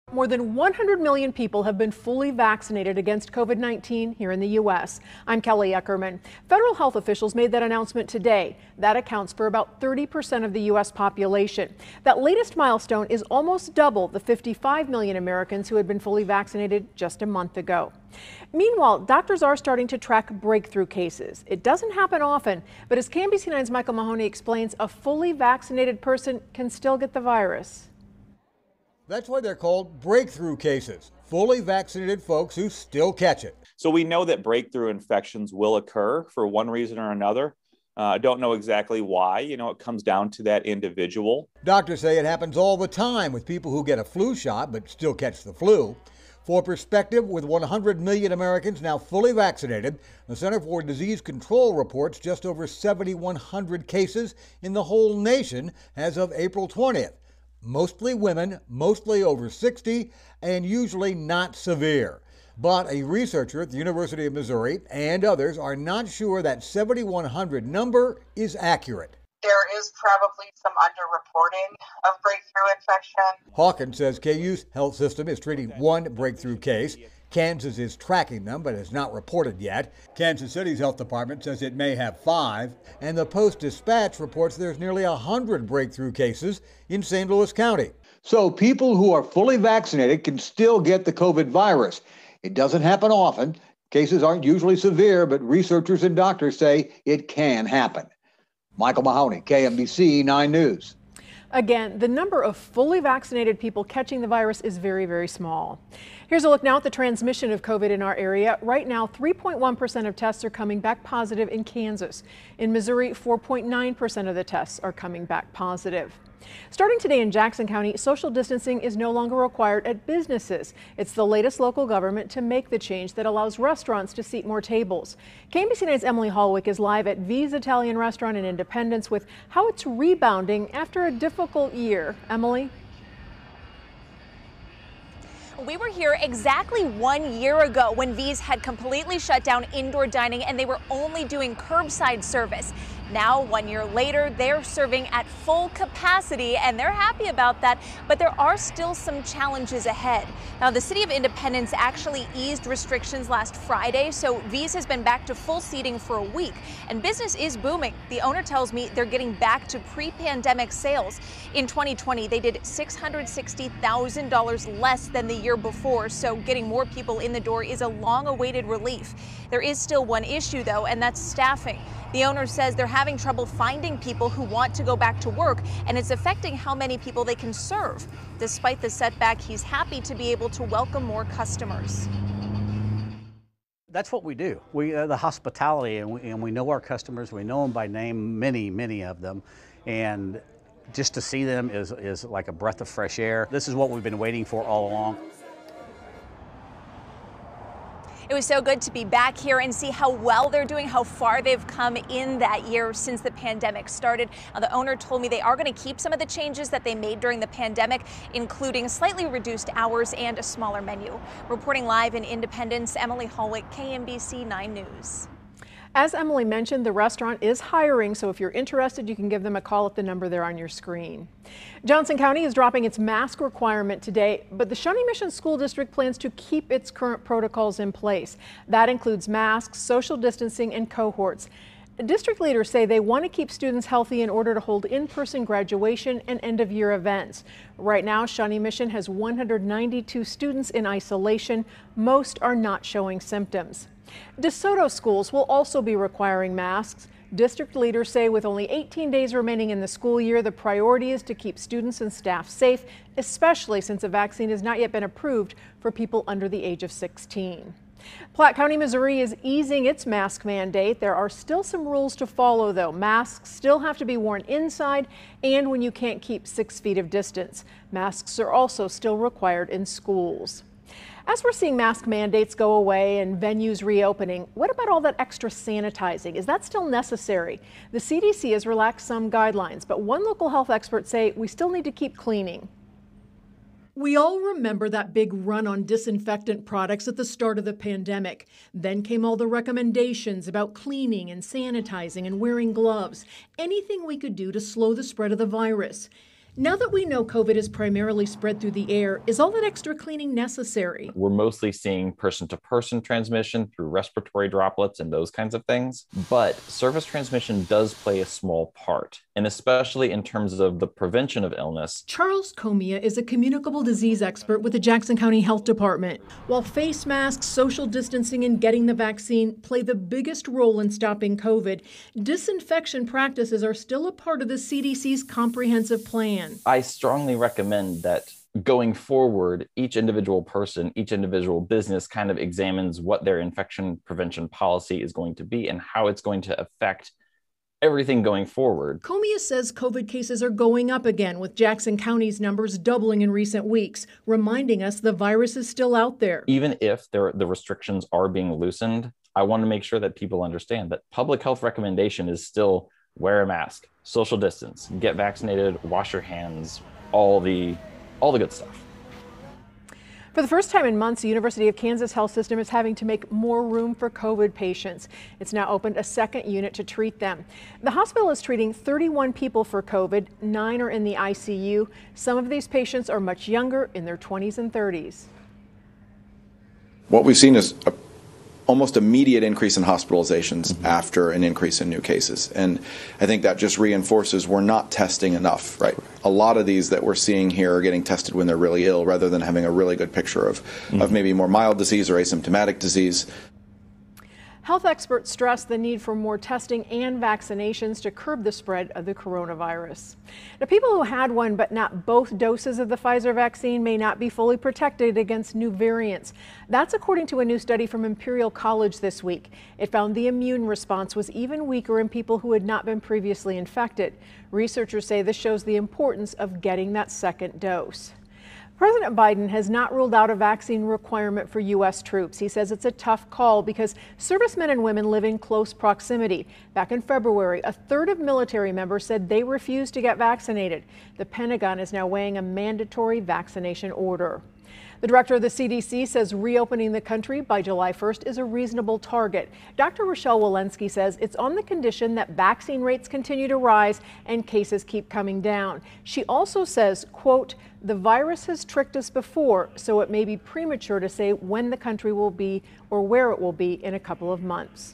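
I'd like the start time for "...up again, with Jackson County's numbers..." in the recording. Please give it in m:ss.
5:40.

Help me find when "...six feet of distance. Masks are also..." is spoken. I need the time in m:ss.
4:26.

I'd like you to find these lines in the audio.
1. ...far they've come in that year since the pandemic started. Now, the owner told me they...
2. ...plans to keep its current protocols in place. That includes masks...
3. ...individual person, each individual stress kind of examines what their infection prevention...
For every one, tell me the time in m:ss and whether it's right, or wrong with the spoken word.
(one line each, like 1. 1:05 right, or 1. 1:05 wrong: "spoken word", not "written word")
1. 3:21 right
2. 3:45 right
3. 5:29 wrong: "business", not "stress".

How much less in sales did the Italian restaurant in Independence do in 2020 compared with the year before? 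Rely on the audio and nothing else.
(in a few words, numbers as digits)
$660,000.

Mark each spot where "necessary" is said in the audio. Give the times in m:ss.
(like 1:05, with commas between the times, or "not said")
4:36, 5:00.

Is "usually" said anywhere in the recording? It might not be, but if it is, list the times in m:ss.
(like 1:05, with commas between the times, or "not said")
1:00, 1:34.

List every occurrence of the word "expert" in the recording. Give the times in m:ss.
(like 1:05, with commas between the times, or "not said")
4:40, 5:14, 6:34.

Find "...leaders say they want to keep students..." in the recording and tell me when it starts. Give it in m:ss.
3:52.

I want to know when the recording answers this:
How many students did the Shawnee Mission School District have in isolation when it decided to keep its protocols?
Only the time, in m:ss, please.
3:59.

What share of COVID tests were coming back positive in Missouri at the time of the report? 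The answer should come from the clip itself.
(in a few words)
4.9%.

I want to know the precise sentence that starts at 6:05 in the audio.
It's now opened a second unit to treat them.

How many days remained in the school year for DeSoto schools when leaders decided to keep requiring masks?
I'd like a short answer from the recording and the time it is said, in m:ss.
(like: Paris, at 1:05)
18, at 4:08.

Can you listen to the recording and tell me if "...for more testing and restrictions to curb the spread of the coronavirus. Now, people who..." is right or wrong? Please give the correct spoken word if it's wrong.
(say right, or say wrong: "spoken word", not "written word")
wrong: "vaccinations", not "restrictions".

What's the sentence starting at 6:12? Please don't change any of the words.
Some of these patients are much younger, in their 20s and 30s.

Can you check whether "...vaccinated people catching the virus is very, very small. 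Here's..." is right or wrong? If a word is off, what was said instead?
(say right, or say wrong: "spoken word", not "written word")
right.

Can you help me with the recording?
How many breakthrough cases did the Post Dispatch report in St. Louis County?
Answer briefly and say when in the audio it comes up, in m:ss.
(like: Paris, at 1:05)
nearly 100, at 1:24.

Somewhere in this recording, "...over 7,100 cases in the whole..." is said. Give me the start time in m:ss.
0:52.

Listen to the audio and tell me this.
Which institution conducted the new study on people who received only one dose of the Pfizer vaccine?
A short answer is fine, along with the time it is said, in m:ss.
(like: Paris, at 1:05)
Imperial College, at 6:48.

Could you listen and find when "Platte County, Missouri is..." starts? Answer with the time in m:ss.
4:18.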